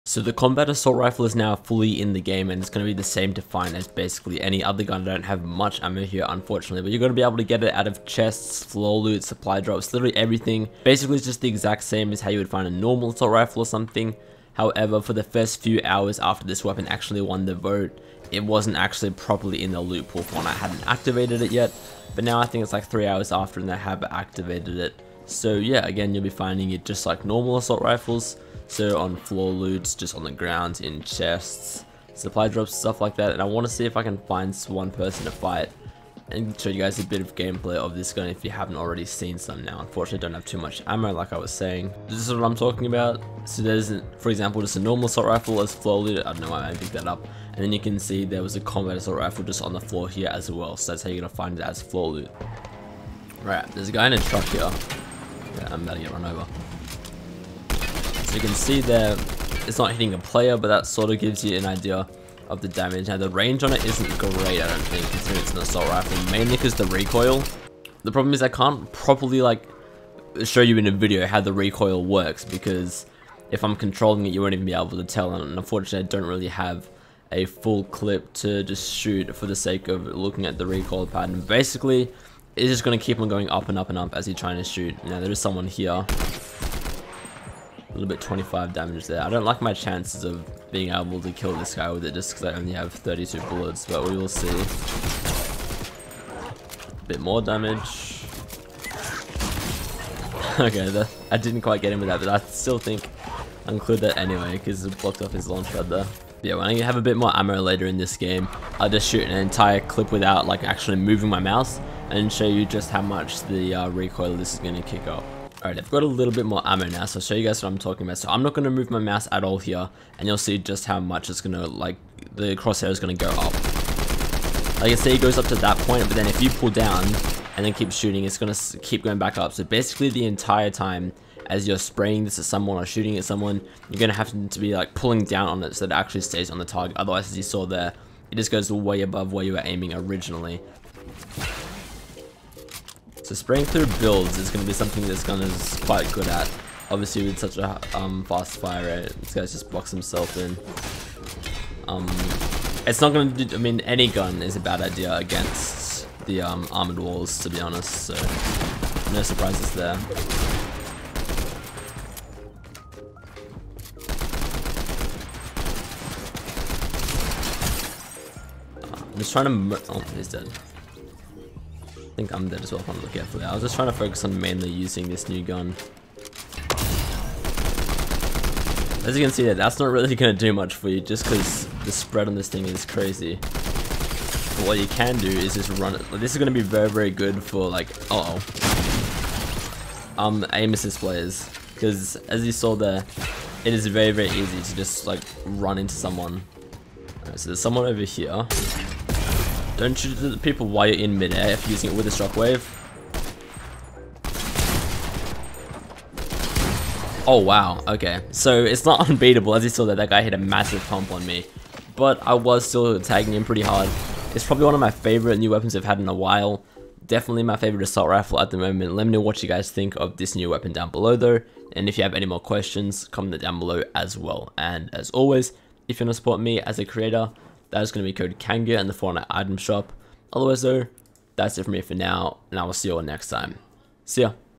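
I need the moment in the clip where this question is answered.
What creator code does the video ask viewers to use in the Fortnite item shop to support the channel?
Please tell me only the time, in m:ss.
3:48.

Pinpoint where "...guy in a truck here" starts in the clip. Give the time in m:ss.
0:53.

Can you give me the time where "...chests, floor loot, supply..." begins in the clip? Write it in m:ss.
0:08.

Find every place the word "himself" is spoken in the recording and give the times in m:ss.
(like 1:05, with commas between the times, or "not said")
2:29.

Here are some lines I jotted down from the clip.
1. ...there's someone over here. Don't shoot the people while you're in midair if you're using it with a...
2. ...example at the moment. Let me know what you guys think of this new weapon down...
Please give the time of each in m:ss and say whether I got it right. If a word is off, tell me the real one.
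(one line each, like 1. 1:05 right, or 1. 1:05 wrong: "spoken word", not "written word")
1. 3:17 right
2. 3:38 wrong: "rifle", not "example".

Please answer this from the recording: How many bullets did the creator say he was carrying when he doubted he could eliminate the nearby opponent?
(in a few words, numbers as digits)
32.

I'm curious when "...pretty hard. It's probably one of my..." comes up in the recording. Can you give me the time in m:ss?
3:33.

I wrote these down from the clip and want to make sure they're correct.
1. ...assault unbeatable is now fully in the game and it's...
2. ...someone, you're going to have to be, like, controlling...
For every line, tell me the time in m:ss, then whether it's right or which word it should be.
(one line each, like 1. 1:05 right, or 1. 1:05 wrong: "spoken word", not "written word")
1. 0:00 wrong: "rifle", not "unbeatable"
2. 2:13 wrong: "pulling", not "controlling".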